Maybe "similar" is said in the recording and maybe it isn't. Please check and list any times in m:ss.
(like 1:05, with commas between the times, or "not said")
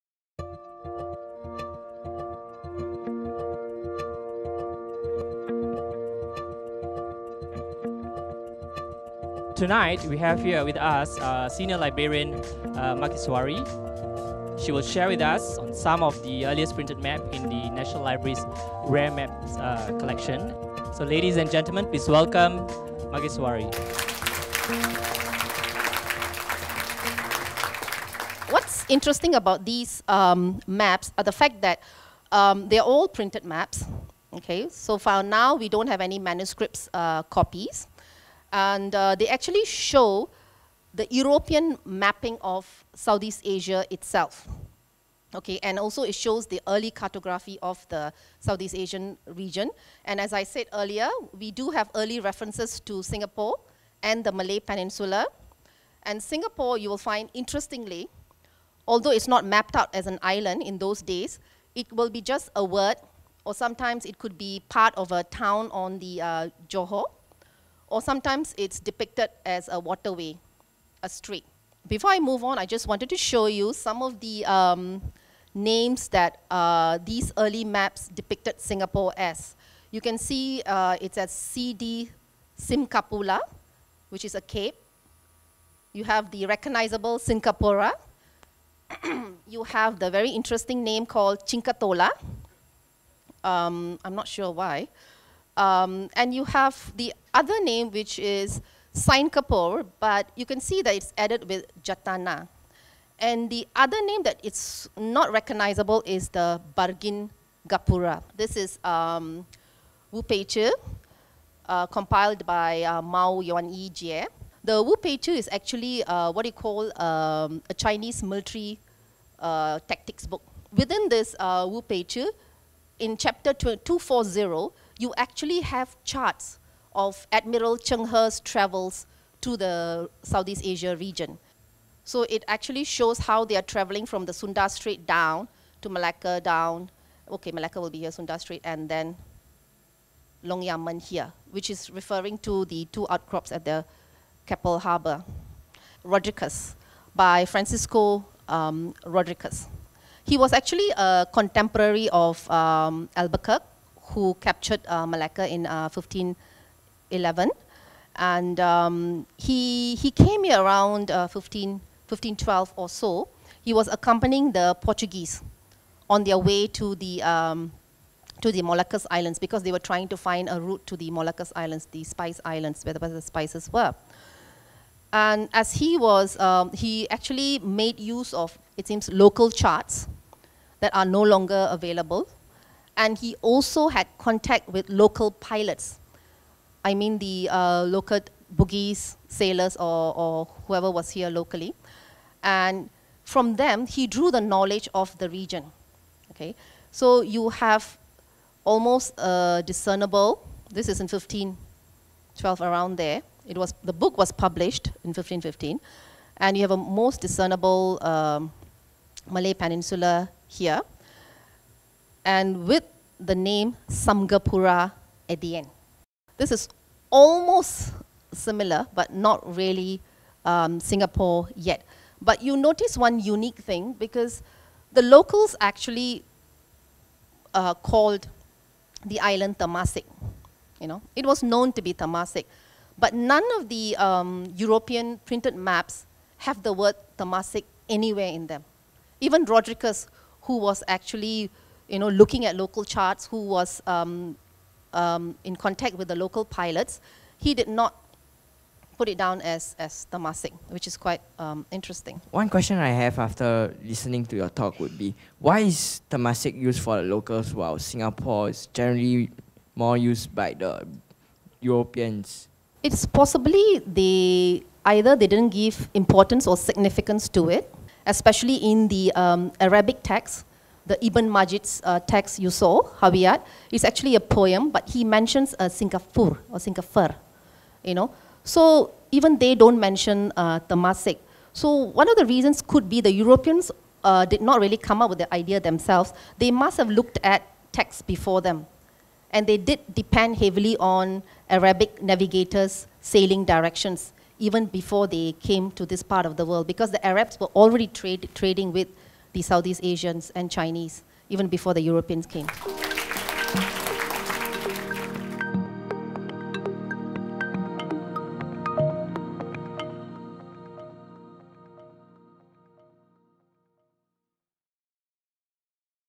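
3:38.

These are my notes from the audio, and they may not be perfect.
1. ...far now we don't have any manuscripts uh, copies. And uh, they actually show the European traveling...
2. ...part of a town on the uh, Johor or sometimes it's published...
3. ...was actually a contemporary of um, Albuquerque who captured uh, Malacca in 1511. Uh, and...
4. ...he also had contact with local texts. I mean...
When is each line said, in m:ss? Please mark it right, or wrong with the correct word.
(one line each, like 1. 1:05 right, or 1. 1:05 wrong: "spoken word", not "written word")
1. 0:34 wrong: "mapping", not "traveling"
2. 1:04 wrong: "depicted", not "published"
3. 2:30 right
4. 3:03 wrong: "pilots", not "texts".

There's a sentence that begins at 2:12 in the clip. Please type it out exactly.
So it actually shows how they are traveling from the Sunda Strait down to Malacca down.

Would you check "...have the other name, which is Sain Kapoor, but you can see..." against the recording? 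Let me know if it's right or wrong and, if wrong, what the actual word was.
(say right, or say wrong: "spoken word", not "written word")
right.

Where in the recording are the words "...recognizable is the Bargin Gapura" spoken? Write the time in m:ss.
1:45.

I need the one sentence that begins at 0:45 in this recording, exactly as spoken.
Okay, and also it shows the early cartography of the Southeast Asian region.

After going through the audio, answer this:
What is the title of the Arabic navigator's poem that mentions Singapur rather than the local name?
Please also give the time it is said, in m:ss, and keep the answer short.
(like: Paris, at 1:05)
Hawiyat, at 4:33.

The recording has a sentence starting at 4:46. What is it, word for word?
They must have looked at texts before them.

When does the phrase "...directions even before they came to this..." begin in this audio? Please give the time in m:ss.
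4:53.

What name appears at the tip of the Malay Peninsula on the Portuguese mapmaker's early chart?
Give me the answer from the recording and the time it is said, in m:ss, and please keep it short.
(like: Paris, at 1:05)
Samgapura, at 3:33.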